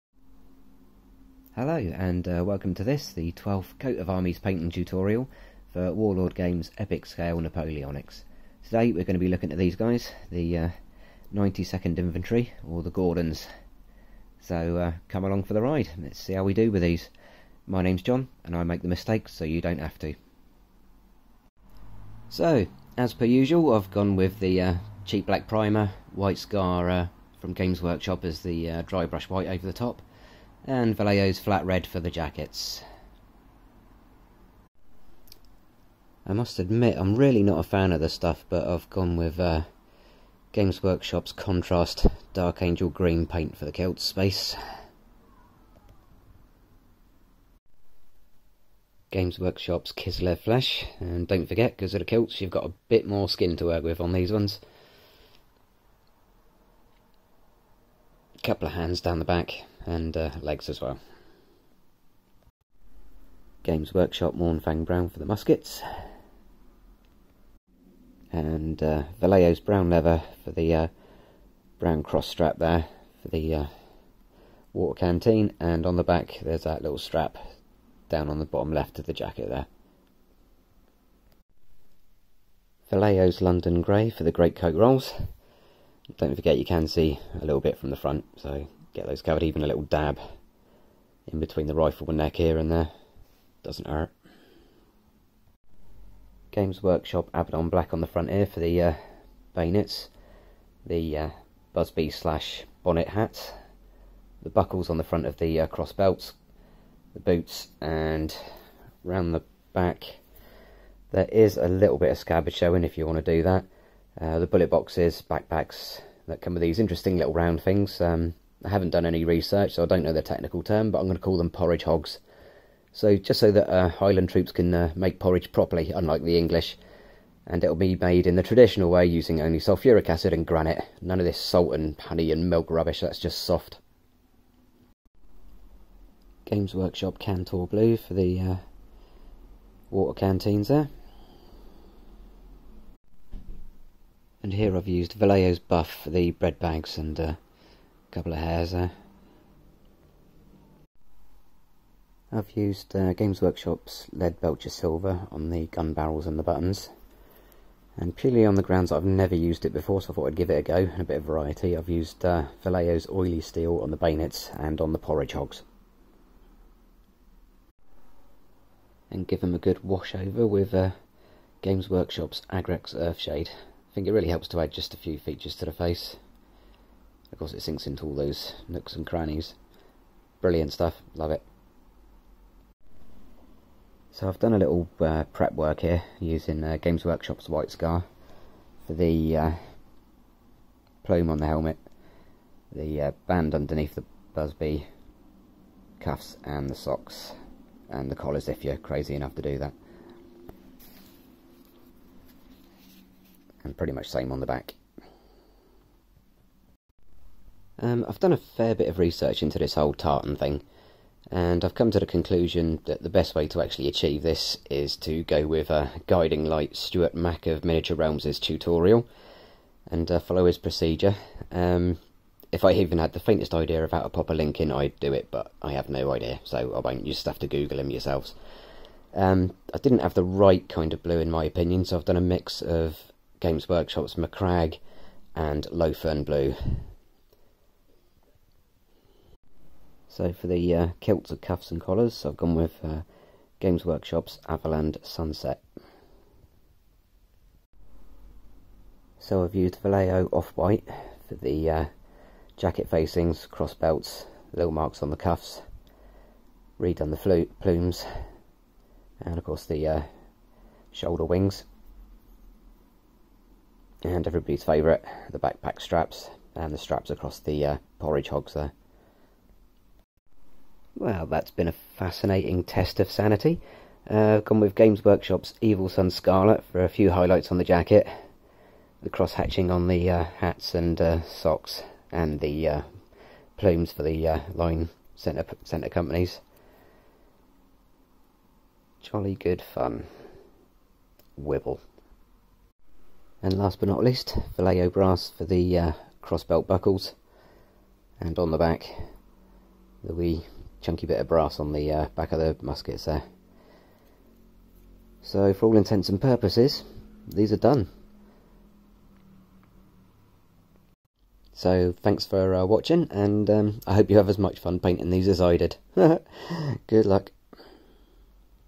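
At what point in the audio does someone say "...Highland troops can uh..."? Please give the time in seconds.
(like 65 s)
123 s.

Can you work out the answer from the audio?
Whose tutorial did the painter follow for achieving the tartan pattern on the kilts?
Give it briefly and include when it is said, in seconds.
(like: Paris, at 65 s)
Stuart Mack, at 216 s.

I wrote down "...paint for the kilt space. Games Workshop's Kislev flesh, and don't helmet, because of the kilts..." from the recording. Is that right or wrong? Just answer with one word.
wrong.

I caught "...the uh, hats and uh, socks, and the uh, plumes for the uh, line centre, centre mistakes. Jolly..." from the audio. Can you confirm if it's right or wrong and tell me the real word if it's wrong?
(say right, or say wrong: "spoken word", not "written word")
wrong: "companies", not "mistakes".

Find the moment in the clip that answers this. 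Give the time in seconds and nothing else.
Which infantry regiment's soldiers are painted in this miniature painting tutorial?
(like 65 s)
11 s.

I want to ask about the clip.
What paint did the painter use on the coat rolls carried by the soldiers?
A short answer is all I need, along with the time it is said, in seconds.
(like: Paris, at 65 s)
Vallejo London Grey, at 82 s.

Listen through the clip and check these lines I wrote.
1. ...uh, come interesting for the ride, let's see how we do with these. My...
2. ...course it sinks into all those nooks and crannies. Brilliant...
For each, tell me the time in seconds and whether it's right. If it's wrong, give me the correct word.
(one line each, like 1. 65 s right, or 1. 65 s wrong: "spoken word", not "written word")
1. 14 s wrong: "along", not "interesting"
2. 177 s right.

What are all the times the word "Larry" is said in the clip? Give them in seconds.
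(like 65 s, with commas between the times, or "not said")
not said.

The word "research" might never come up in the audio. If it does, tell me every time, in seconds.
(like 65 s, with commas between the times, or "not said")
119 s, 208 s.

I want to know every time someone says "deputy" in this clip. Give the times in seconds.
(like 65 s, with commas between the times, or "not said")
not said.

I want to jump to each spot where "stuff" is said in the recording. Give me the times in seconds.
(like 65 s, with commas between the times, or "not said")
38 s, 180 s.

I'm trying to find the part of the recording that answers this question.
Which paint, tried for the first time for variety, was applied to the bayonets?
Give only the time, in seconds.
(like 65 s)
162 s.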